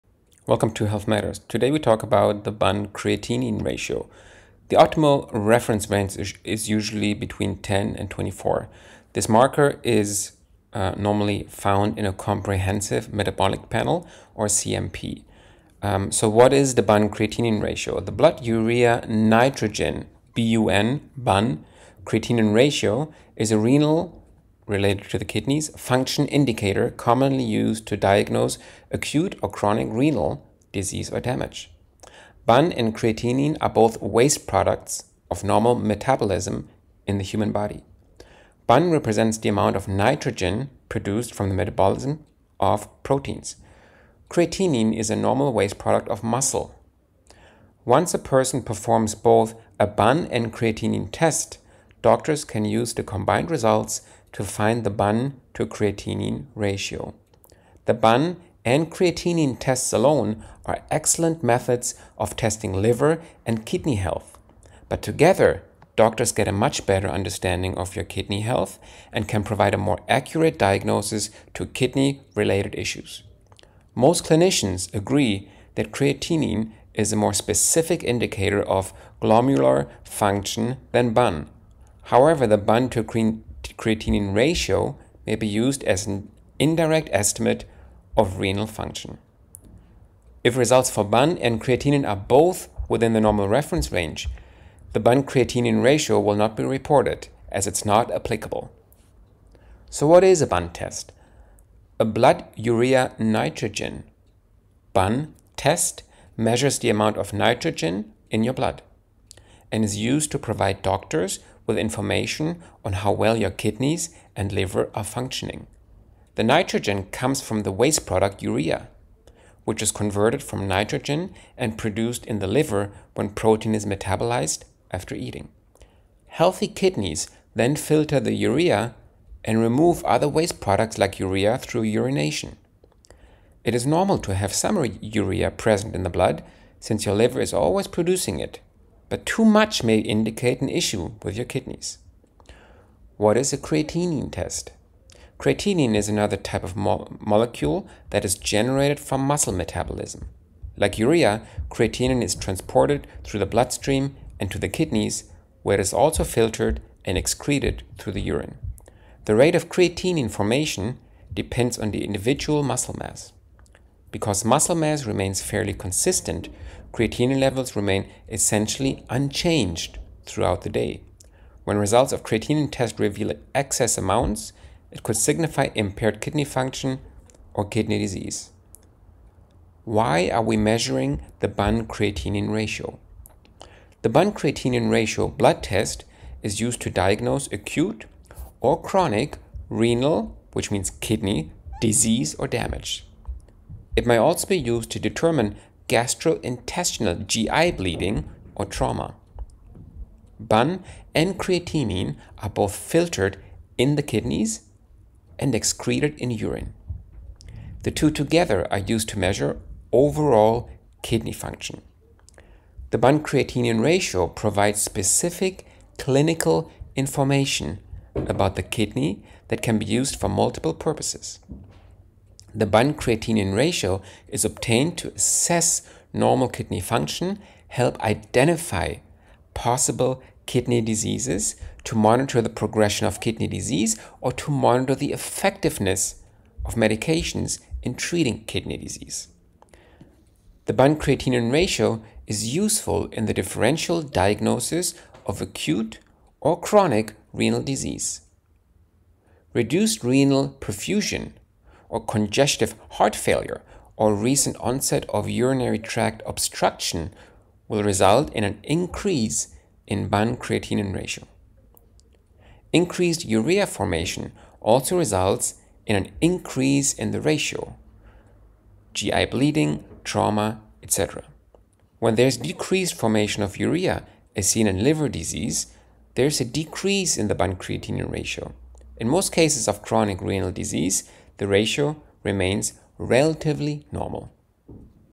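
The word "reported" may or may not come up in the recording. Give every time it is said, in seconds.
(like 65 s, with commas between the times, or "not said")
96 s.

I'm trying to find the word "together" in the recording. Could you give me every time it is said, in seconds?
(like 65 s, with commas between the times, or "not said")
65 s, 208 s.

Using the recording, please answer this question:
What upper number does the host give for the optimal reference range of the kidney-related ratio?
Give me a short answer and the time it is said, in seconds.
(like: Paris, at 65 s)
24, at 8 s.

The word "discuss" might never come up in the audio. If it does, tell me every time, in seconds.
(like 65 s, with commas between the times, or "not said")
not said.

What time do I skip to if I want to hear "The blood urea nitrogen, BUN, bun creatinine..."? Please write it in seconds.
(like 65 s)
18 s.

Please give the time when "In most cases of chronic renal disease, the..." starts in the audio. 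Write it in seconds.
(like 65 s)
278 s.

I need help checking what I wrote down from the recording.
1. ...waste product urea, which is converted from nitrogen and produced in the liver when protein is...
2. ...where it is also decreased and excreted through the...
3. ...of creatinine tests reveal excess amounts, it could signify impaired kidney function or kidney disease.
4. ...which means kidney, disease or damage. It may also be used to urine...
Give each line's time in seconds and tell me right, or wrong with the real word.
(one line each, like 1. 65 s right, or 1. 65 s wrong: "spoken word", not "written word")
1. 117 s right
2. 155 s wrong: "filtered", not "decreased"
3. 172 s right
4. 190 s wrong: "determine", not "urine".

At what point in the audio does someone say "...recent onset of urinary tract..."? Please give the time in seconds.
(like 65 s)
254 s.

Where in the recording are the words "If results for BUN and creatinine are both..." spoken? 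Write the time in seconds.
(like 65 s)
90 s.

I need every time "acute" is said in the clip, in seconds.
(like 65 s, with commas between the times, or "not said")
28 s, 187 s, 245 s.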